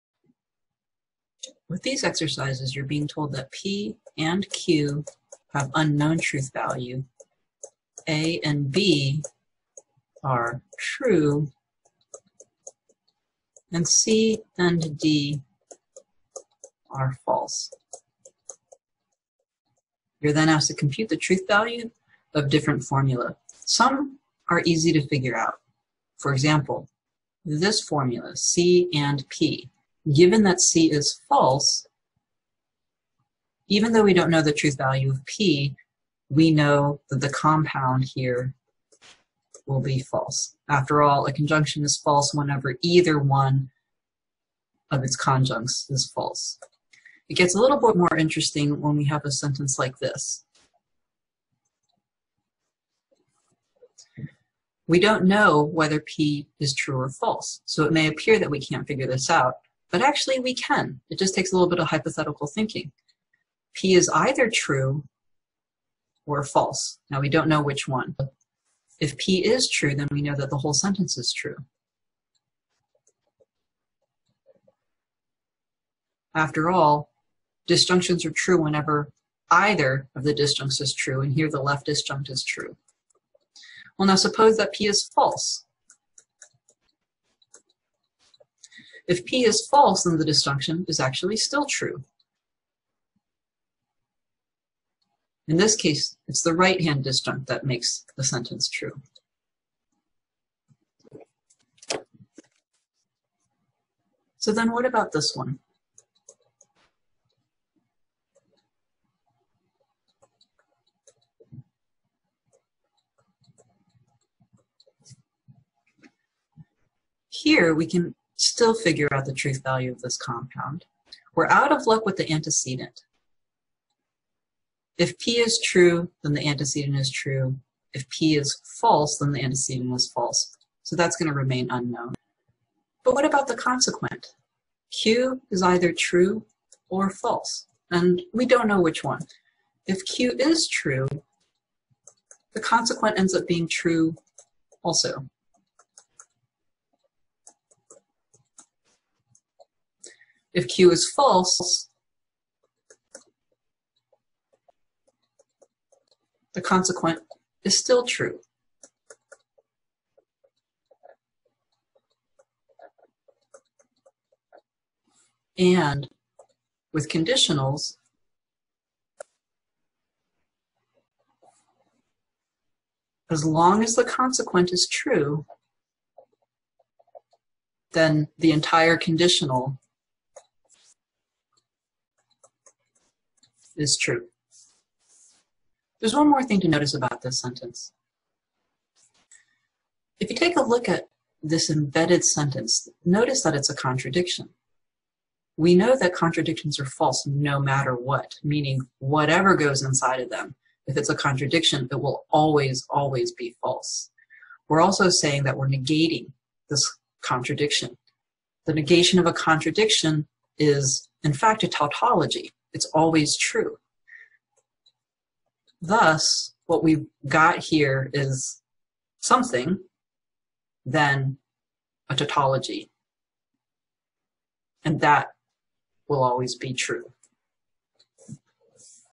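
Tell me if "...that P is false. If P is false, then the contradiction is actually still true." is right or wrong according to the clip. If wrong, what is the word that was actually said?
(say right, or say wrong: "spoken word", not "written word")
wrong: "disjunction", not "contradiction".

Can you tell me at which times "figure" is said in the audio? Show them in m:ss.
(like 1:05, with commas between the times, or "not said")
0:25, 0:58, 1:58.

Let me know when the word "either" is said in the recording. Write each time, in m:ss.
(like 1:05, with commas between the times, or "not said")
0:42, 1:04, 1:19, 2:15.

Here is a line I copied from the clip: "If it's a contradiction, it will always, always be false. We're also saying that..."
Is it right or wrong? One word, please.
right.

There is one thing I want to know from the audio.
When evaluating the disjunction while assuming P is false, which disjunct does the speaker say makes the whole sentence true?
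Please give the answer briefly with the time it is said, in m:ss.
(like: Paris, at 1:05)
The right-hand disjunct, at 1:36.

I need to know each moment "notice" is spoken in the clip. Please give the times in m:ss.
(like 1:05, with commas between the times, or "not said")
3:06, 3:13.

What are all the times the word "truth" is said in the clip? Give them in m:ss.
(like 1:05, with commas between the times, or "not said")
0:06, 0:21, 0:34, 1:59.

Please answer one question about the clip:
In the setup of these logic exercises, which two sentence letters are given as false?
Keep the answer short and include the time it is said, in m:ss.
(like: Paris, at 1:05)
C and D, at 0:13.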